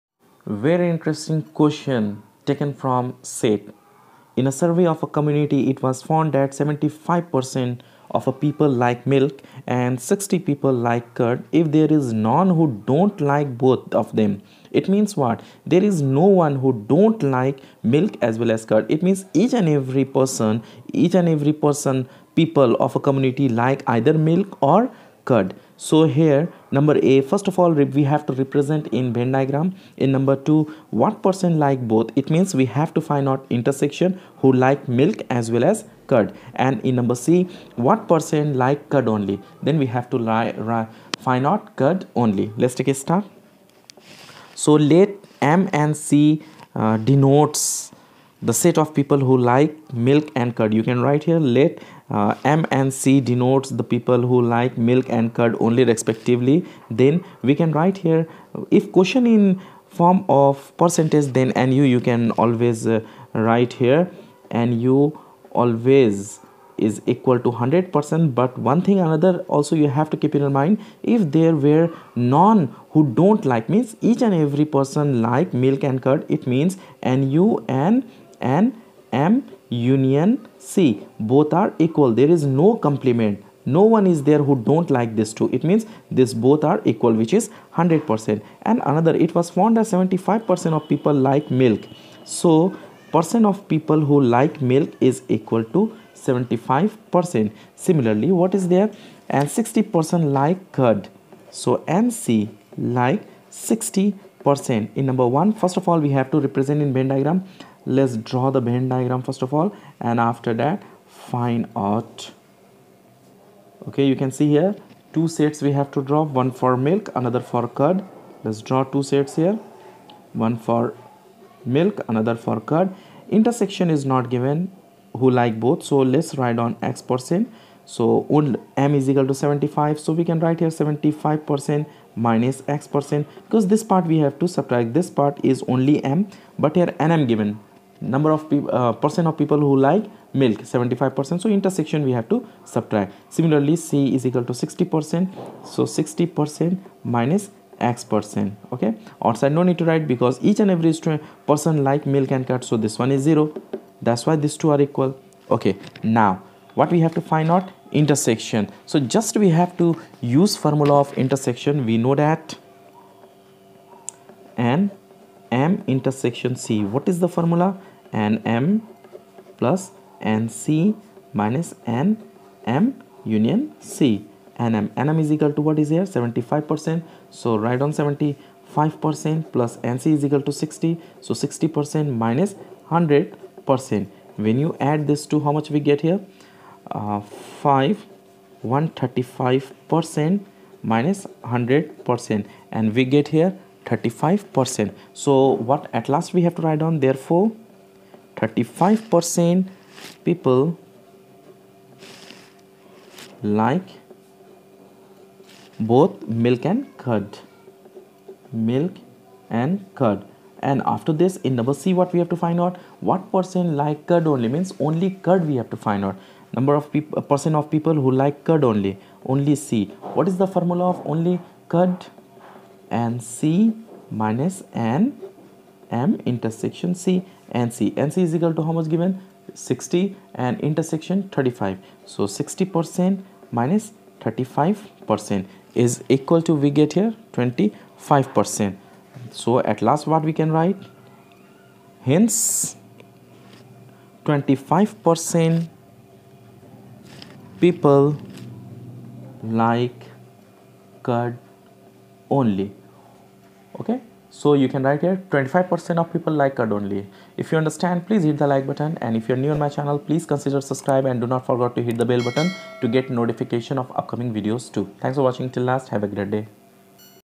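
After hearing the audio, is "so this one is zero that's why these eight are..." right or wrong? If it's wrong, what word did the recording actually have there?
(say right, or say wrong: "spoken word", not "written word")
wrong: "two", not "eight".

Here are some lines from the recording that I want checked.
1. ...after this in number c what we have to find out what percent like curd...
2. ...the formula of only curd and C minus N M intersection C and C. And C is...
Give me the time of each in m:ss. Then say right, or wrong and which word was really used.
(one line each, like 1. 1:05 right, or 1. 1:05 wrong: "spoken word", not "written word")
1. 3:30 right
2. 3:40 right.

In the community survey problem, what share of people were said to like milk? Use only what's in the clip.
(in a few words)
75%.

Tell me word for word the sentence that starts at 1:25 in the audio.
It means this both are equal which is 100%.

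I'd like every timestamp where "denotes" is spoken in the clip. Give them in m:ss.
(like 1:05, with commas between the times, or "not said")
0:46, 0:53.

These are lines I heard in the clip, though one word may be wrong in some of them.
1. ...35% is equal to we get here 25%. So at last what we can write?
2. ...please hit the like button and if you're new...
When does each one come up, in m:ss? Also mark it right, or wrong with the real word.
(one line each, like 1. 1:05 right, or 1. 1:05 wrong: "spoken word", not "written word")
1. 3:53 right
2. 4:18 right.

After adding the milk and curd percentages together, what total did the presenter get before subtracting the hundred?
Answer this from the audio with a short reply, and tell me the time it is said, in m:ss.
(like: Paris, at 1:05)
135%, at 3:08.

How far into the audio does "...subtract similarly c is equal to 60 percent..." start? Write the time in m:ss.
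2:22.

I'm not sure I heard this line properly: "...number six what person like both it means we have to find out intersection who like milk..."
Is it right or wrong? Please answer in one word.
wrong.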